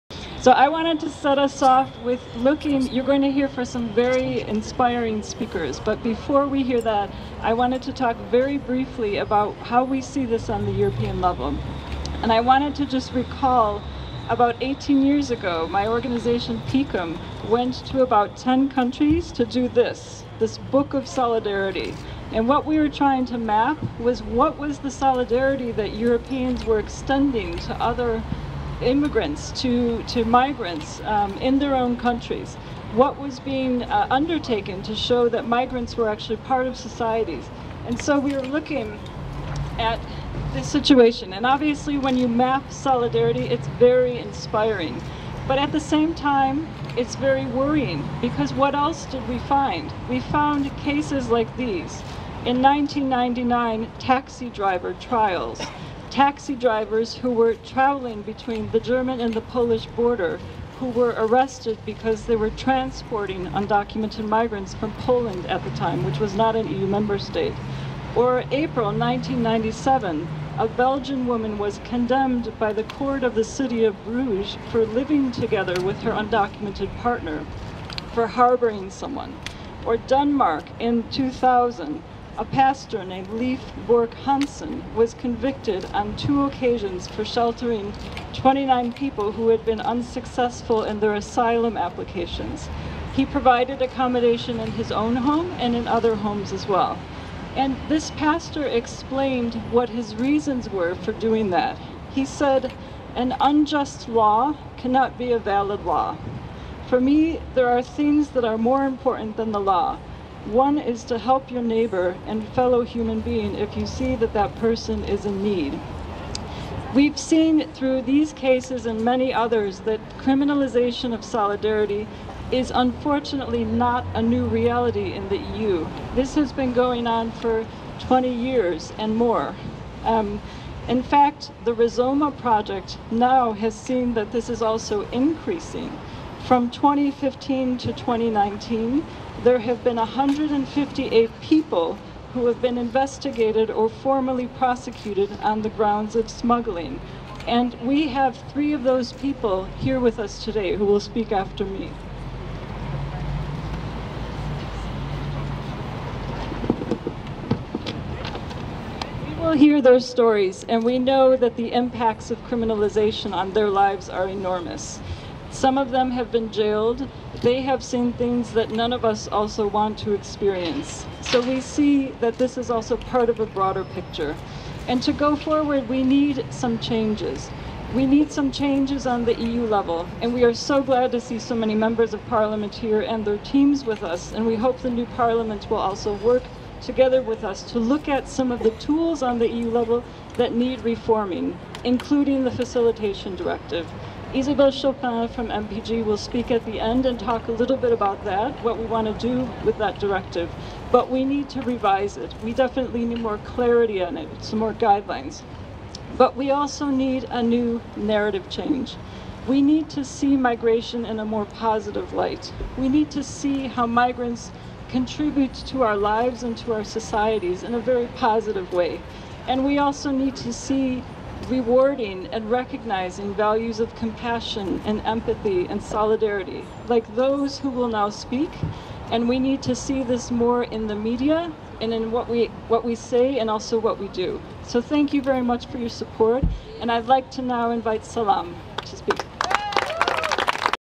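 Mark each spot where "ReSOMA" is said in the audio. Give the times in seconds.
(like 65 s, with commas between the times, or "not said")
131 s.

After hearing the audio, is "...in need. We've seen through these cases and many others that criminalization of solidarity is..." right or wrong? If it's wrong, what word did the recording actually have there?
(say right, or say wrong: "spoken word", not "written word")
right.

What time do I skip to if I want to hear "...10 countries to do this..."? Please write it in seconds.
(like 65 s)
18 s.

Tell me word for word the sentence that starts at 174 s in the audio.
And to go forward, we need some changes.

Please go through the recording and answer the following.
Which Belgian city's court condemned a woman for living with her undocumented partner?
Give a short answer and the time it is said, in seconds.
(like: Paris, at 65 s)
Bruges, at 74 s.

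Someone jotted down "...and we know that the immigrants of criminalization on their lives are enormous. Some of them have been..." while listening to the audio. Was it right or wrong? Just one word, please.
wrong.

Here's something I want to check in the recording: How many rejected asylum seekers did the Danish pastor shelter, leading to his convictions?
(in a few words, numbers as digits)
29.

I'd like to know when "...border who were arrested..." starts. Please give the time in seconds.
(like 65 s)
59 s.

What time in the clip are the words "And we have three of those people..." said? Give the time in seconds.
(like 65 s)
147 s.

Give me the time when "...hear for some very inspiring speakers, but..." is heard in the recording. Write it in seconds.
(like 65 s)
3 s.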